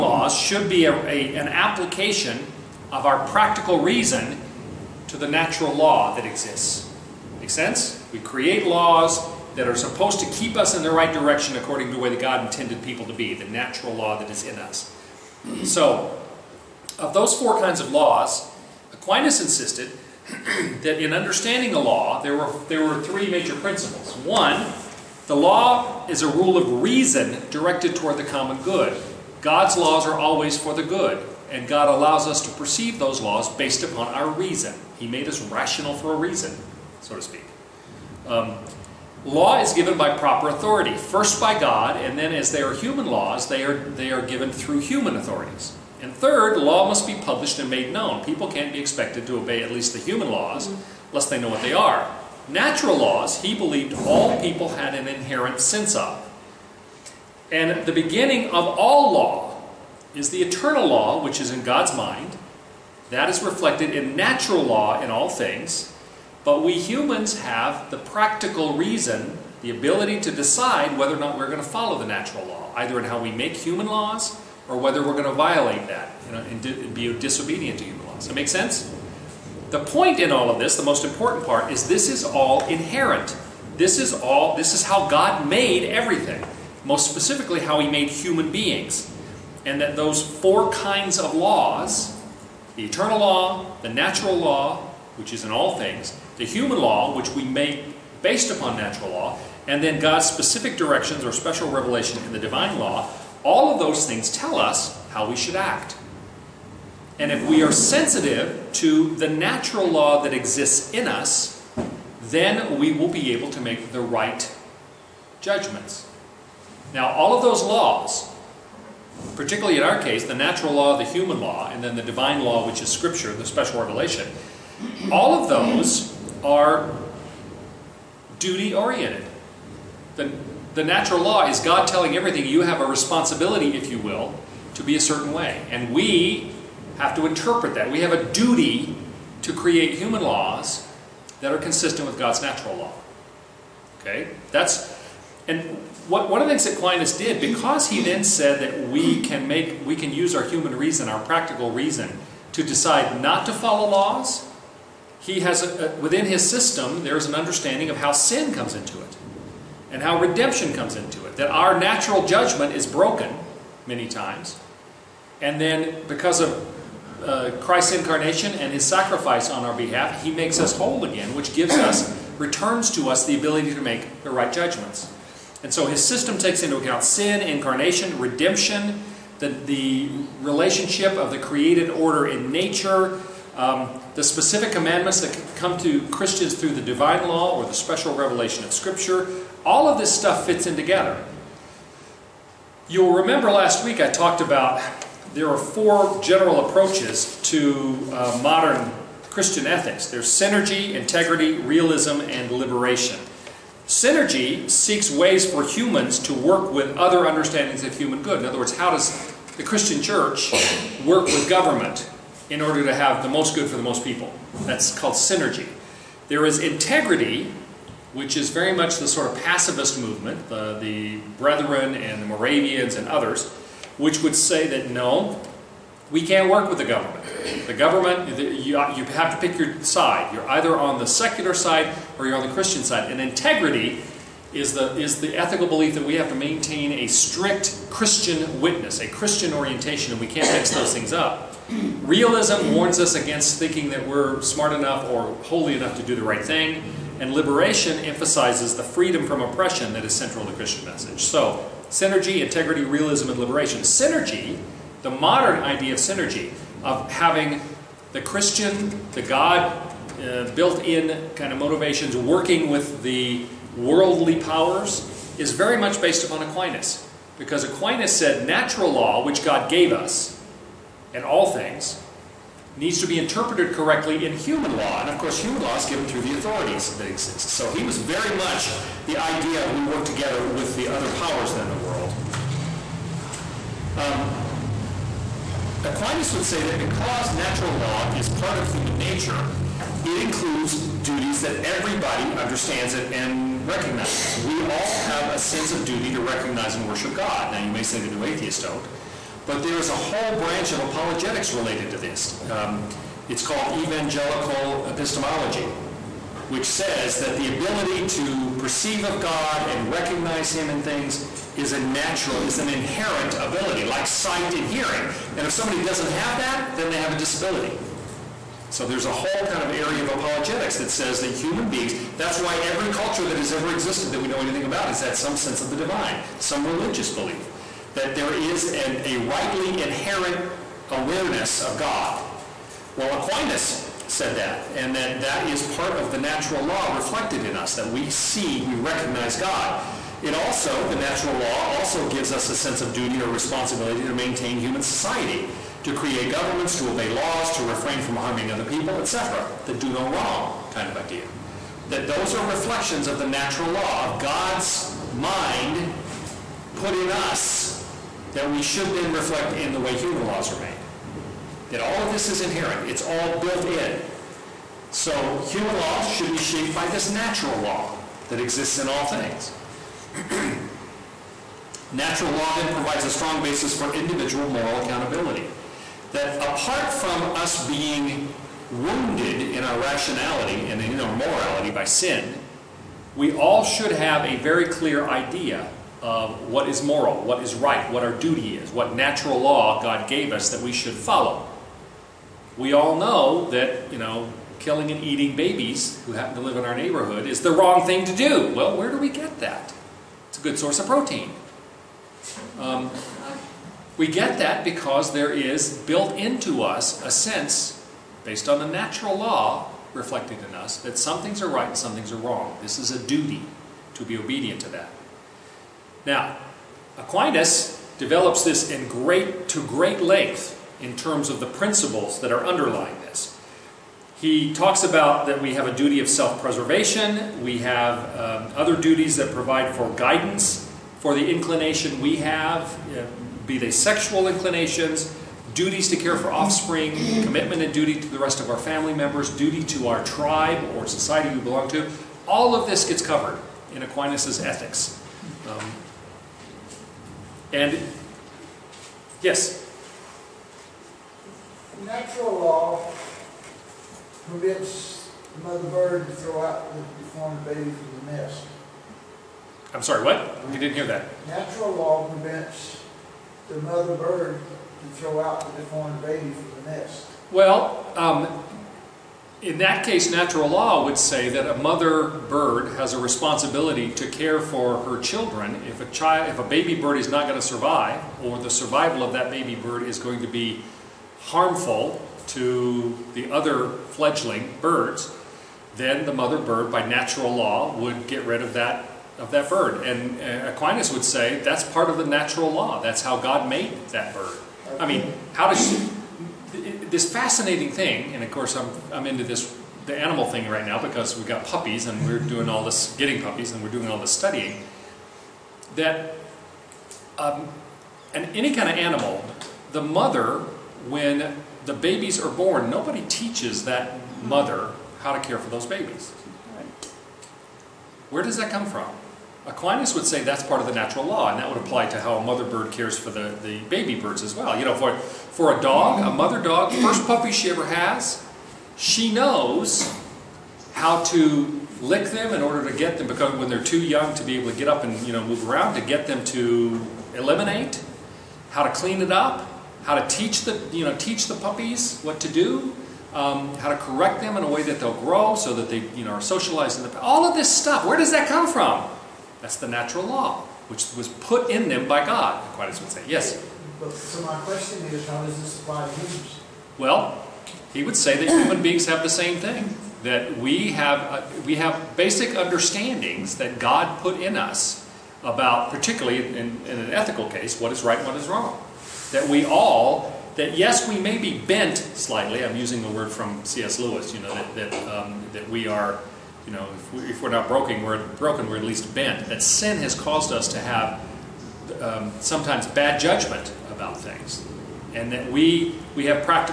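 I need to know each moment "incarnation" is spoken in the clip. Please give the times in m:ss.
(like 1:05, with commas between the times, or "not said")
2:47, 2:57.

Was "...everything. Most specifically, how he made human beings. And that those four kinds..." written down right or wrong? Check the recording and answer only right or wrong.
right.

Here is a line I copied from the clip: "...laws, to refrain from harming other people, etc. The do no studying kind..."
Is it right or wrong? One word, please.
wrong.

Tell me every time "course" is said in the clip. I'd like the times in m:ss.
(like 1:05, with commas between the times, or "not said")
4:35, 8:18.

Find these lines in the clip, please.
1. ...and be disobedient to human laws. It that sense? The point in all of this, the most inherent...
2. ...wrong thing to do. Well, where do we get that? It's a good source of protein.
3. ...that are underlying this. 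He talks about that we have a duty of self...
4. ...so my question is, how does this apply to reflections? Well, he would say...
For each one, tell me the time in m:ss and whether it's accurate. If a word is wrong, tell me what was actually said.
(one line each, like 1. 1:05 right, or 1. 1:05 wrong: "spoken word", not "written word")
1. 1:16 wrong: "important", not "inherent"
2. 6:37 right
3. 7:02 right
4. 9:13 wrong: "humans", not "reflections".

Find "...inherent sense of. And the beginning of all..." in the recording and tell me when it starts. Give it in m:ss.
0:55.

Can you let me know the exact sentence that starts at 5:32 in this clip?
Well, Aquinas said that, and that that is part of the natural law reflected in us, that we see, we recognize God.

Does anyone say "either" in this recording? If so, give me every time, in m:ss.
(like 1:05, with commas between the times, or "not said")
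1:12, 3:50.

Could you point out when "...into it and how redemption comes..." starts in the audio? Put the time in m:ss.
2:38.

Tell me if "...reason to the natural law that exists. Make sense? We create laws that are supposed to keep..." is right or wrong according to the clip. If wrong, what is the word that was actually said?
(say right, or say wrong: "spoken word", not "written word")
right.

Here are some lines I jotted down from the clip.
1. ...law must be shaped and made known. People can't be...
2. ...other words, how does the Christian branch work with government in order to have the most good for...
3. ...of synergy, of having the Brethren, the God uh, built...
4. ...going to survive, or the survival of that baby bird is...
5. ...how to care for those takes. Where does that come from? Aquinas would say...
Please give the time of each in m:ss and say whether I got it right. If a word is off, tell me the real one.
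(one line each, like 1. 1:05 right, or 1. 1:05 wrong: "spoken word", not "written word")
1. 0:46 wrong: "published", not "shaped"
2. 3:28 wrong: "church", not "branch"
3. 4:15 wrong: "Christian", not "Brethren"
4. 7:57 right
5. 8:34 wrong: "babies", not "takes".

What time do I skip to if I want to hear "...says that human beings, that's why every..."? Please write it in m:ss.
5:20.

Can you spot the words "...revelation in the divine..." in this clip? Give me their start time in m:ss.
1:41.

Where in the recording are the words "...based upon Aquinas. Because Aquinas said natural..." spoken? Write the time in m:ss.
4:25.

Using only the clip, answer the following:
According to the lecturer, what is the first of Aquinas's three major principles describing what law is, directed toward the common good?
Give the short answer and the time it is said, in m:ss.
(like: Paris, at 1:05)
A rule of reason, at 0:26.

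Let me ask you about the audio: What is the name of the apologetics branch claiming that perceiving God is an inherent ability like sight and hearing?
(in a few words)
Evangelical epistemology.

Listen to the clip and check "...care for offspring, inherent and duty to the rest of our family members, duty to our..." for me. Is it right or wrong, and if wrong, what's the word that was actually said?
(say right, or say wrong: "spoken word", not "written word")
wrong: "commitment", not "inherent".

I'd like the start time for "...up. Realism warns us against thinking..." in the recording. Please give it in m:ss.
4:01.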